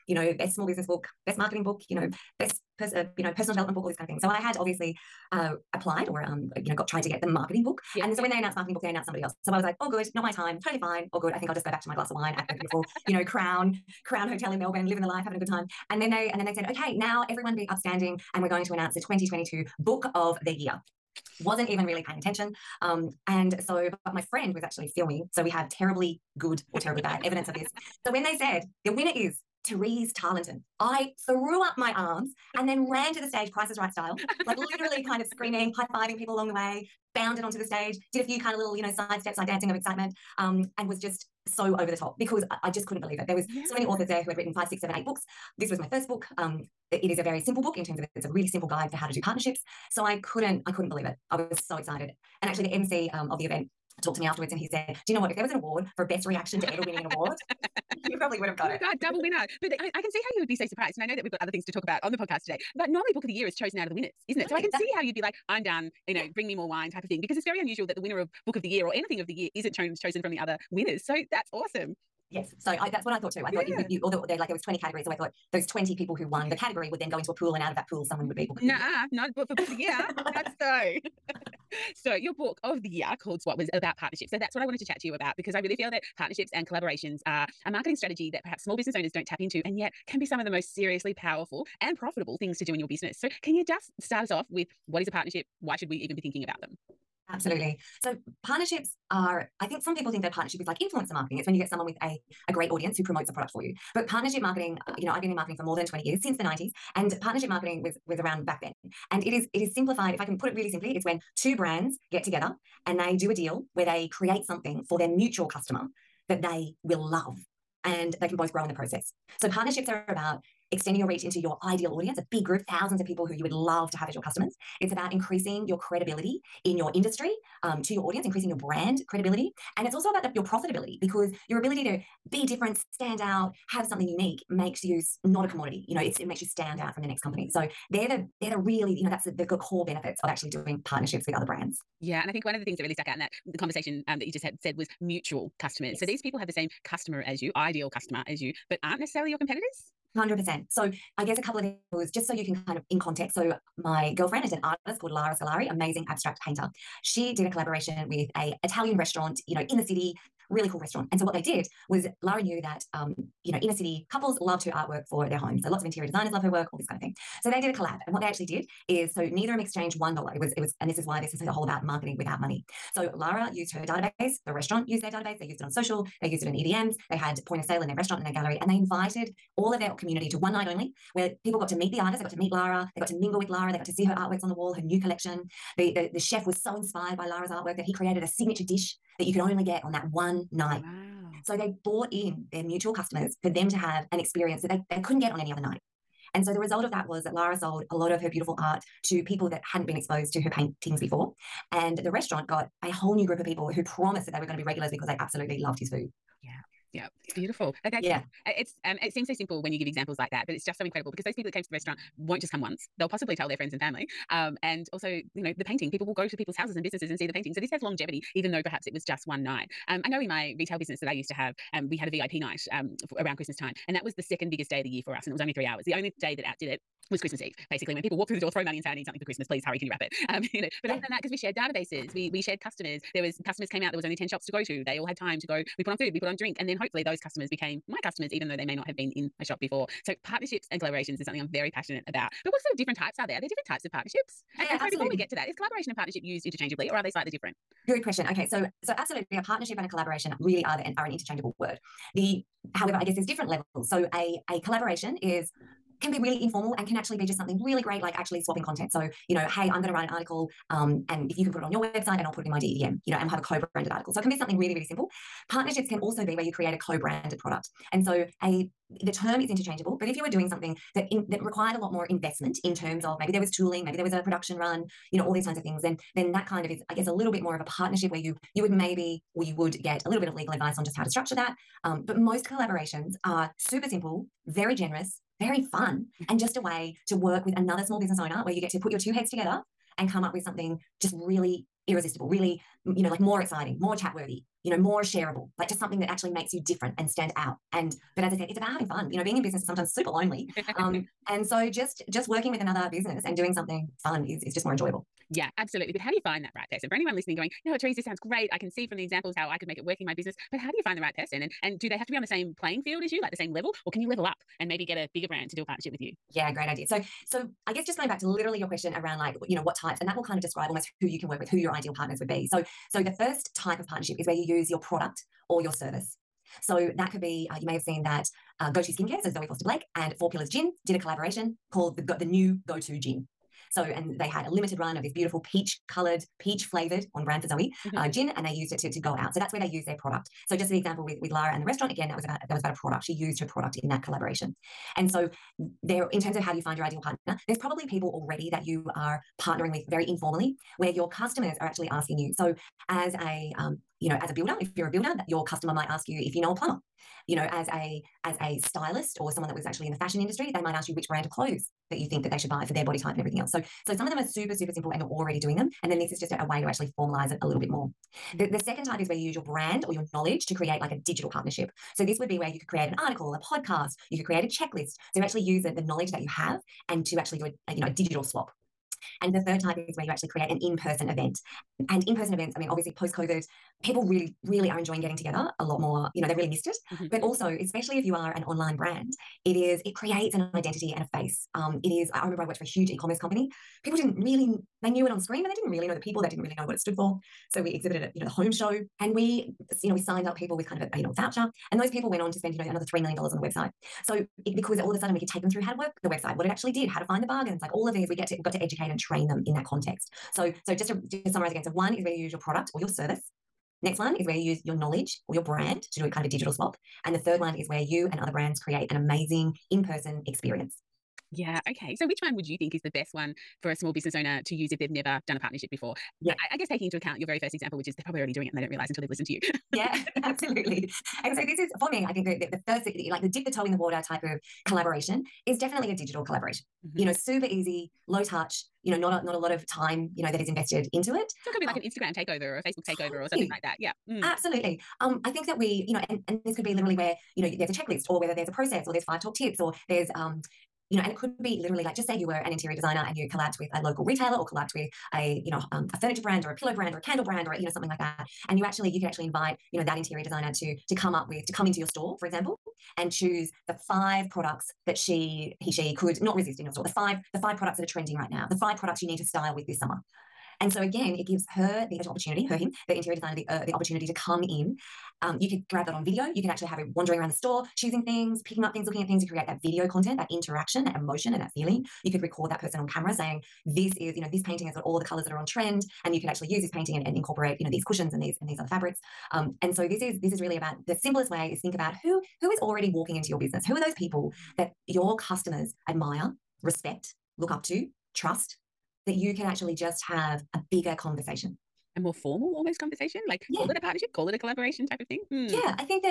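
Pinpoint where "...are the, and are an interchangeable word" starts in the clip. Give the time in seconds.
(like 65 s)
250 s.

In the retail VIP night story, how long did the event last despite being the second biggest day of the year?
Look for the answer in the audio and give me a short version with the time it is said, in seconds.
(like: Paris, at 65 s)
3 hours, at 225 s.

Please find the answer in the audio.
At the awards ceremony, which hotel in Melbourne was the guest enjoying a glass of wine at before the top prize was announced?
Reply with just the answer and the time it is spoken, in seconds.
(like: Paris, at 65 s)
Crown Hotel, at 13 s.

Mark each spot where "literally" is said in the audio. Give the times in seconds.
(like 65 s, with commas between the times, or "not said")
34 s, 318 s, 446 s, 451 s.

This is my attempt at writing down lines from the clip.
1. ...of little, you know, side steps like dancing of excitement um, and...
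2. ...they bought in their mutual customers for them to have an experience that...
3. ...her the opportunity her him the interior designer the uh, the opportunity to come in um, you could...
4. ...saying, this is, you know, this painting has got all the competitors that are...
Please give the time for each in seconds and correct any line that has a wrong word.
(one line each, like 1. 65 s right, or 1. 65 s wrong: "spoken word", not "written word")
1. 38 s right
2. 191 s right
3. 471 s right
4. 483 s wrong: "colors", not "competitors".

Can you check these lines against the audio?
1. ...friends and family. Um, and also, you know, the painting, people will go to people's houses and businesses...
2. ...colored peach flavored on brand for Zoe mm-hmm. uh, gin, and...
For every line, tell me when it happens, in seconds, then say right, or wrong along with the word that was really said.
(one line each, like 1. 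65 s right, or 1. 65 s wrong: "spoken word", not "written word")
1. 213 s right
2. 335 s right.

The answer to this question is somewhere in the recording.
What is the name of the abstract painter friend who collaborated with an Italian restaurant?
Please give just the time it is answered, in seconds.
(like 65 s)
155 s.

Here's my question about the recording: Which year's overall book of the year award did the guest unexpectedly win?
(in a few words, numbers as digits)
2022.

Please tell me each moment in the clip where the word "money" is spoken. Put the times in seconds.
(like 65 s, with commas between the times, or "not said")
172 s, 228 s.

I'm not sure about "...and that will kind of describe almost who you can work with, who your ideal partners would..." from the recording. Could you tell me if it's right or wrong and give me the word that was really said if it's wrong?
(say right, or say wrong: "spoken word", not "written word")
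right.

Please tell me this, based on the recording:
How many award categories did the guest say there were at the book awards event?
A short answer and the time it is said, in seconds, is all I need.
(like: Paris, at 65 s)
20, at 74 s.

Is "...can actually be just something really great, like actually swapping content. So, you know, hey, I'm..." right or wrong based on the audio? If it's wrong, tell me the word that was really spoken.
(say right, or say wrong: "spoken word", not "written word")
right.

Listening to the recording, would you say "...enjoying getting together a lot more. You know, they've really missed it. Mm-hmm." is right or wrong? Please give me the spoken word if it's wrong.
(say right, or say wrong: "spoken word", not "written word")
right.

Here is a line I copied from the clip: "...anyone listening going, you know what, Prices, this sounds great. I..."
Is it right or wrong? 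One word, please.
wrong.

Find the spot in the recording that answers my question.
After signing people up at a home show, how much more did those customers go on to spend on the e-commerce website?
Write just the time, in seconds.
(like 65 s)
402 s.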